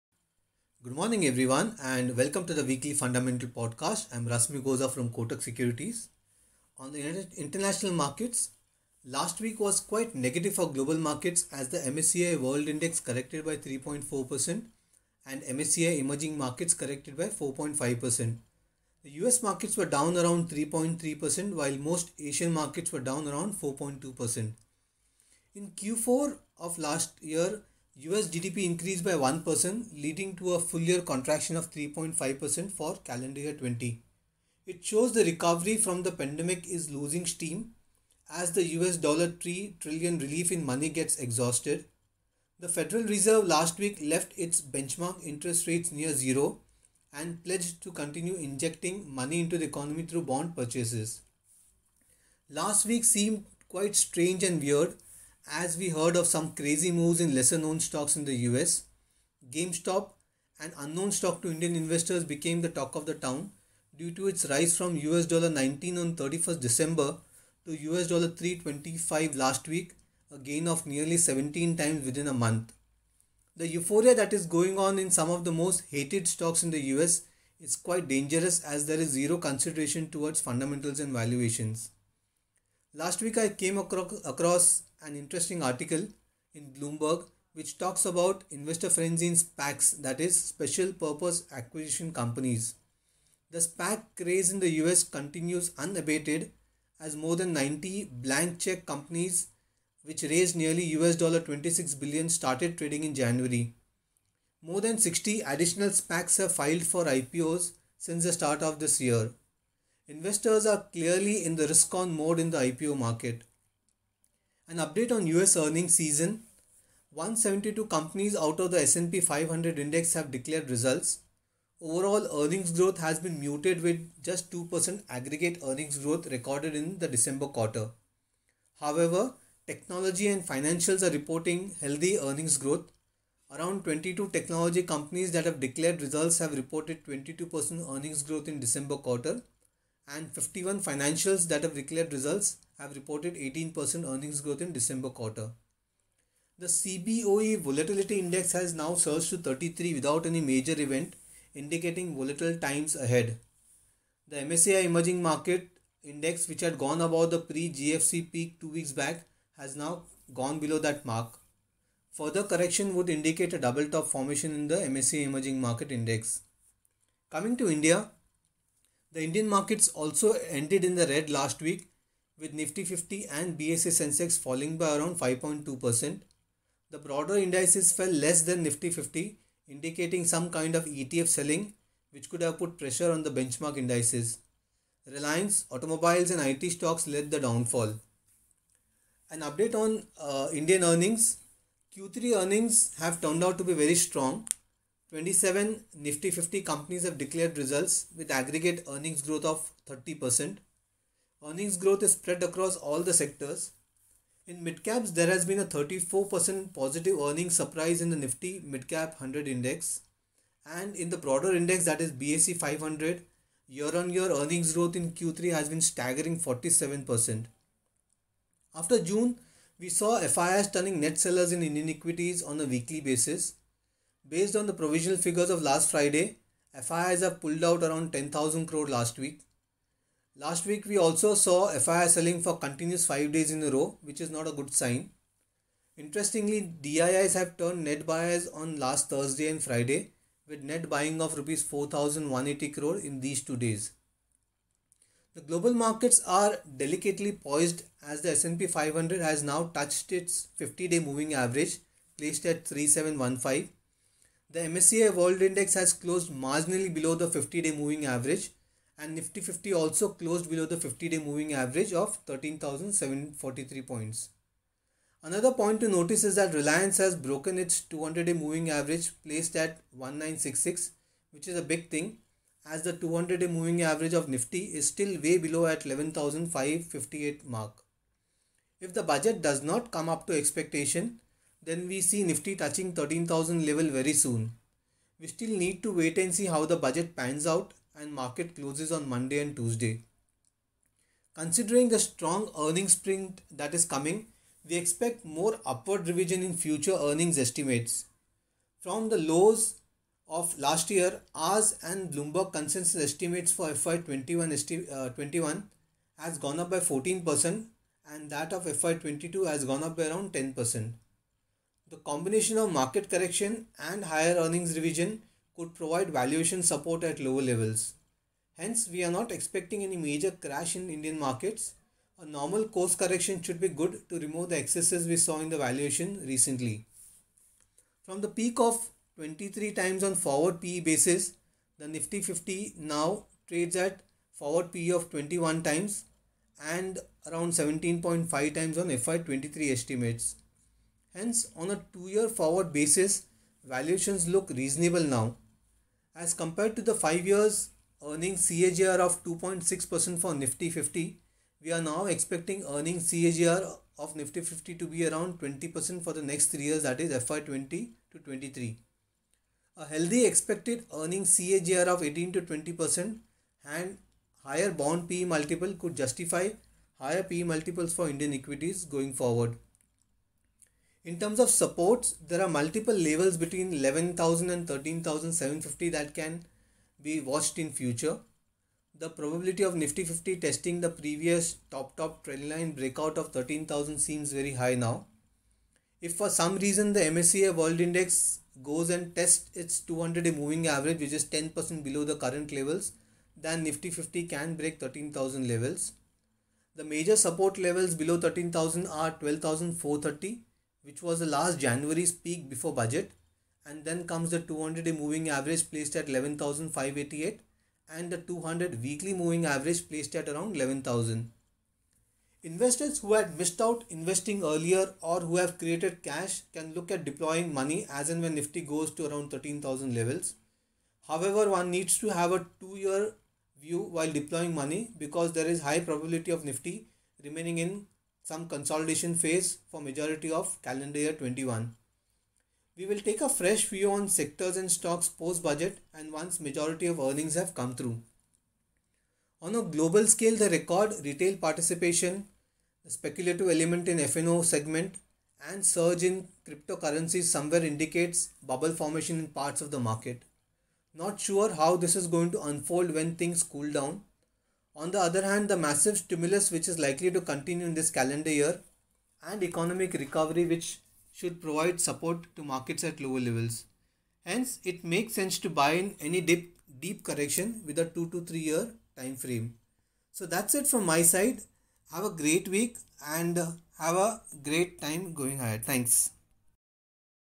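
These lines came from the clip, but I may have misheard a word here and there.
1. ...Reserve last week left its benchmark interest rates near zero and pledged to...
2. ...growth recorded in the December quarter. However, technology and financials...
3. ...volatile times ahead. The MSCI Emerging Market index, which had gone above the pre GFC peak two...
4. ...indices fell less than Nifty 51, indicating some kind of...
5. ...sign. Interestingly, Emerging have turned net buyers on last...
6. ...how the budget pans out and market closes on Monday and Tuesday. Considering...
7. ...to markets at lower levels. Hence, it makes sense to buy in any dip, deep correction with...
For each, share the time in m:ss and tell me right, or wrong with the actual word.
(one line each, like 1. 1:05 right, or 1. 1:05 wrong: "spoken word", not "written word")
1. 0:43 right
2. 2:05 right
3. 2:32 right
4. 2:57 wrong: "50", not "51"
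5. 3:54 wrong: "DIIs", not "Emerging"
6. 4:46 right
7. 7:42 right.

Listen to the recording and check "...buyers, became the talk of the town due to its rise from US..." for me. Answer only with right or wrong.
wrong.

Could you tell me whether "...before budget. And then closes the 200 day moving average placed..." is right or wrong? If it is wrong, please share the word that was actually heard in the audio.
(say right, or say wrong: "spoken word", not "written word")
wrong: "comes", not "closes".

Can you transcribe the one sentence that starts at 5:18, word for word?
Hence, we are not expecting any major crash in Indian markets.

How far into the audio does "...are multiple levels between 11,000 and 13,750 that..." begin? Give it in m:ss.
6:12.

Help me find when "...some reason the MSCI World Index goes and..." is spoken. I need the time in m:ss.
6:26.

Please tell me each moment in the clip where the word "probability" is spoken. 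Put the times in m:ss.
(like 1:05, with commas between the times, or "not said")
6:19, 7:05.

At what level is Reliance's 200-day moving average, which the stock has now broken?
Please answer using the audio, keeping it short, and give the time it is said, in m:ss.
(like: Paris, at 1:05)
1966, at 4:29.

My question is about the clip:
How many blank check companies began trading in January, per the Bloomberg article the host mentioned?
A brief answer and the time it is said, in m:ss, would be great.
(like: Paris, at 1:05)
More than 90, at 1:37.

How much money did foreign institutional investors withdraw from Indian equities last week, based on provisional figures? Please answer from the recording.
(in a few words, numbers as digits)
10,000 crore.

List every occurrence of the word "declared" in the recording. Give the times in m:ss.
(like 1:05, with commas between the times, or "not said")
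2:00, 2:15, 2:21, 3:17.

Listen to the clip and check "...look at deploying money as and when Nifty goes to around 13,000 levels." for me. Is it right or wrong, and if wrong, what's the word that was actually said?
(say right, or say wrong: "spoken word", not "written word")
right.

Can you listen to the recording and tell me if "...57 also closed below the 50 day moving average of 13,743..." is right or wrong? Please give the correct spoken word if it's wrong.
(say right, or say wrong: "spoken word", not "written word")
wrong: "50", not "57".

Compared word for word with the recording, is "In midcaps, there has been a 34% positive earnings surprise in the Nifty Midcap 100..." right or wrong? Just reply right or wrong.
right.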